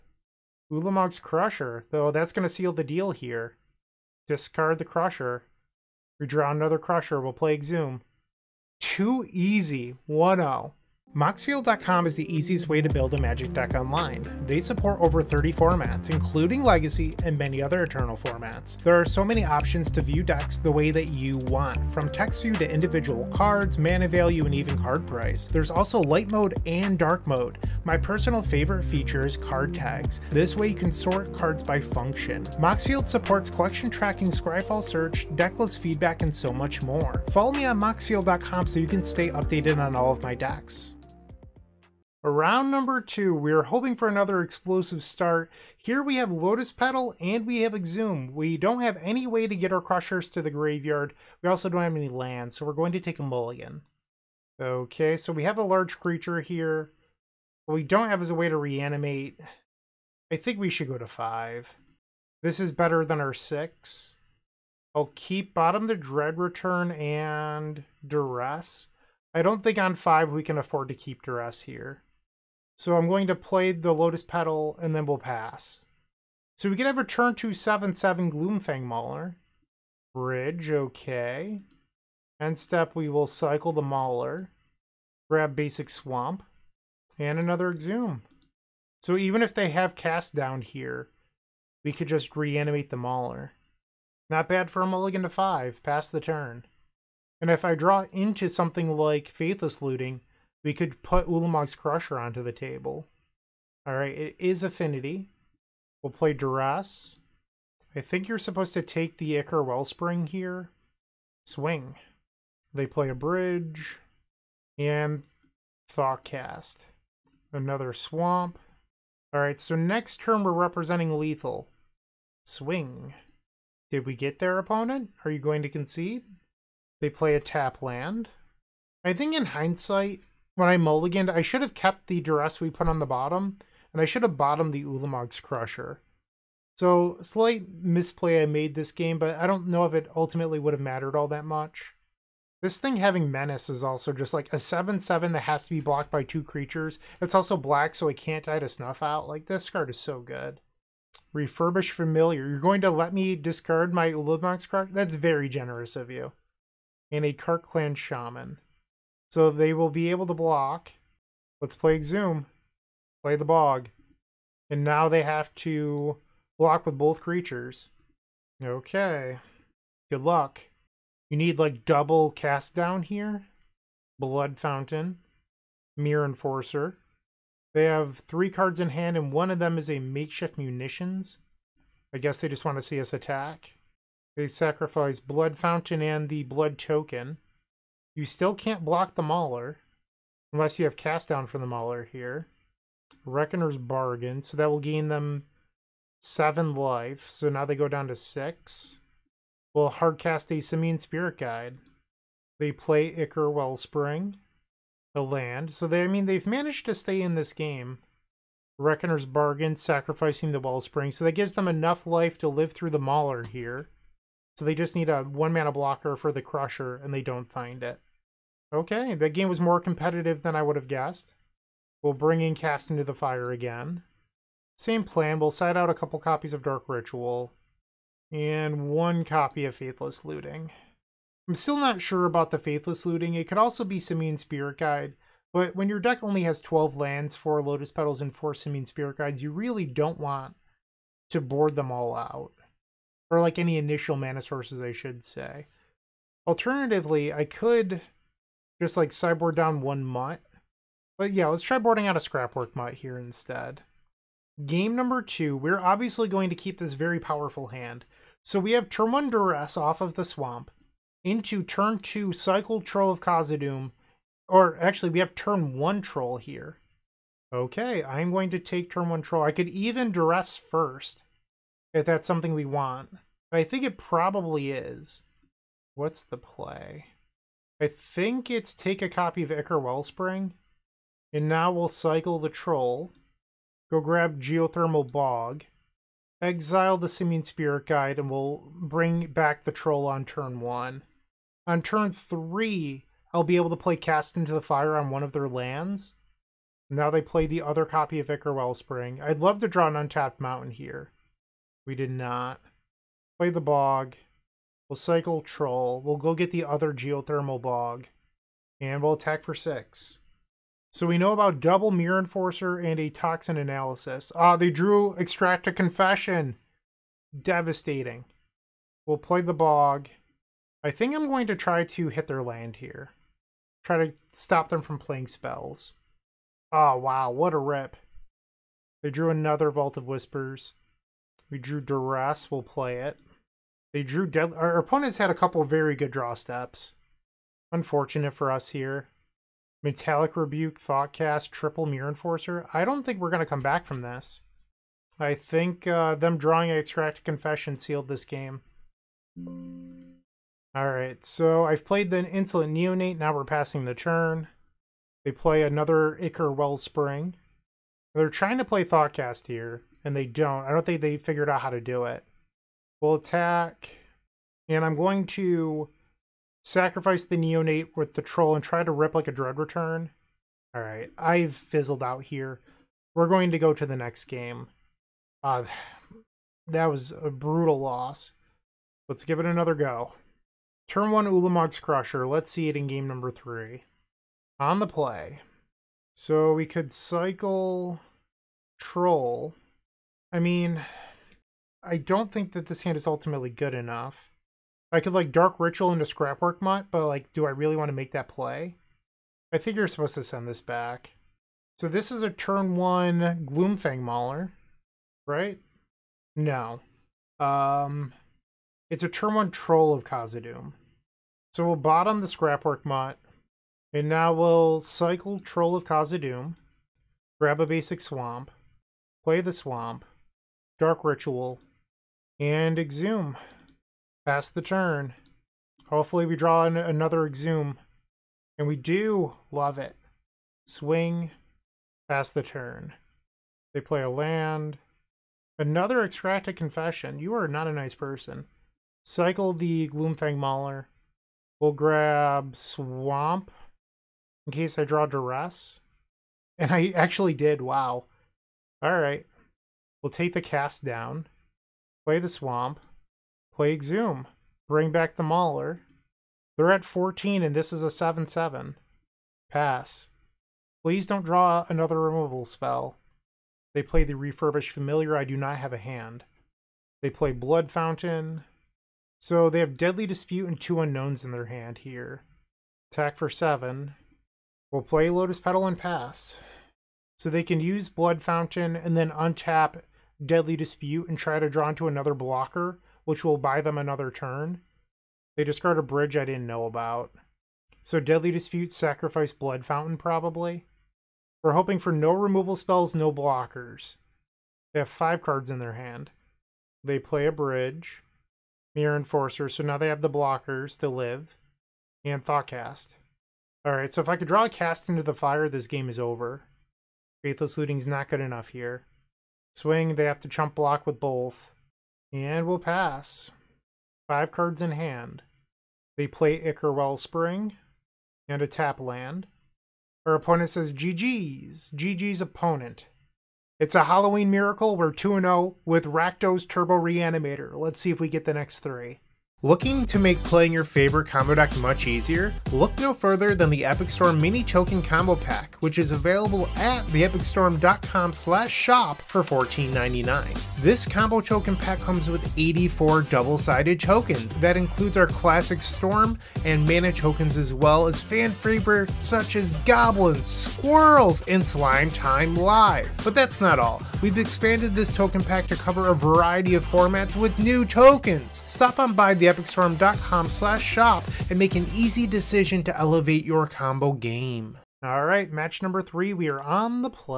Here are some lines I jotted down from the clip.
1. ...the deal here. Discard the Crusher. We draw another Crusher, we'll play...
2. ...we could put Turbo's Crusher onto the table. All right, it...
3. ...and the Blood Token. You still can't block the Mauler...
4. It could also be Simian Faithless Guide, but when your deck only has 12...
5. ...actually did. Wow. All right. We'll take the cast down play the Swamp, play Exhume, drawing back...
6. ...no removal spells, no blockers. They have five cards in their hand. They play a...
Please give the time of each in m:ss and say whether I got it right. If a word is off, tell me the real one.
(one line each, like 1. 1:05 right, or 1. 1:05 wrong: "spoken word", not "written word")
1. 0:02 right
2. 1:40 wrong: "Ulamog", not "Turbo"
3. 3:05 right
4. 3:53 wrong: "Spirit", not "Faithless"
5. 7:26 wrong: "bring", not "drawing"
6. 8:11 right.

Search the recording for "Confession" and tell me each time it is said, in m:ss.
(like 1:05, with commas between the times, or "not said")
5:15, 5:47, 7:16.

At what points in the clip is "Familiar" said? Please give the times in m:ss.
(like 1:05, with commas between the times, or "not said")
2:31, 7:44.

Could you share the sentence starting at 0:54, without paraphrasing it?
Okay, so we have a large creature here.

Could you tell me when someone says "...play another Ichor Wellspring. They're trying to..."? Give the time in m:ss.
5:55.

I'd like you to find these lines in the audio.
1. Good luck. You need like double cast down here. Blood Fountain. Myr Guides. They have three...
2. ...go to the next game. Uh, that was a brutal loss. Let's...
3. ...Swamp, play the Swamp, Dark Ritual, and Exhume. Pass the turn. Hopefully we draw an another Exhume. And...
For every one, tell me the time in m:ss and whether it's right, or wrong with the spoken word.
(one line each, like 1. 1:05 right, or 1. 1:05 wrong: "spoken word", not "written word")
1. 2:50 wrong: "Enforcer", not "Guides"
2. 6:13 right
3. 6:57 right.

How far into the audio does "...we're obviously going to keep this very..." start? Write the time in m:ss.
4:15.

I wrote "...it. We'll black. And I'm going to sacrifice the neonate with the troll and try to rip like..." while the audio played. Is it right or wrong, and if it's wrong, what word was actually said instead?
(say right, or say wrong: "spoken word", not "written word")
wrong: "attack", not "black".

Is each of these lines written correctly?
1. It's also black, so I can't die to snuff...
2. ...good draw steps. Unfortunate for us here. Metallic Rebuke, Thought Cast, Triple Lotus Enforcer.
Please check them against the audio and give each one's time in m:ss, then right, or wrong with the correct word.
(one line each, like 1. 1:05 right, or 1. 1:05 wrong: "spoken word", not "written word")
1. 2:27 right
2. 5:35 wrong: "Myr", not "Lotus".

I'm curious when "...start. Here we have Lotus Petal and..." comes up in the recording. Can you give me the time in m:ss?
0:45.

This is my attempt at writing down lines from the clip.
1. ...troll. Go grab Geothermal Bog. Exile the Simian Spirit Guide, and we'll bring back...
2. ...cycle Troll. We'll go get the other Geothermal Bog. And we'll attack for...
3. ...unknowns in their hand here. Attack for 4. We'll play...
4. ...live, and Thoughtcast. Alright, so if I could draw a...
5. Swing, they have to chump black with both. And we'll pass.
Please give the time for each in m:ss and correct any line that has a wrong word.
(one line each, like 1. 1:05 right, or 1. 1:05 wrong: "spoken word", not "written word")
1. 4:42 right
2. 5:04 right
3. 7:50 wrong: "7", not "4"
4. 8:20 right
5. 8:29 wrong: "block", not "black".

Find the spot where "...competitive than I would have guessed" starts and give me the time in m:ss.
3:39.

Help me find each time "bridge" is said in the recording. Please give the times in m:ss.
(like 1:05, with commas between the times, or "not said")
1:20, 1:53, 8:05, 8:17.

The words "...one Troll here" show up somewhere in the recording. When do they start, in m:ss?
4:25.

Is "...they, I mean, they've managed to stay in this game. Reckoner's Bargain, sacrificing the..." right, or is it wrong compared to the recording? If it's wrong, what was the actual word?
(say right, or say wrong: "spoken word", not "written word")
right.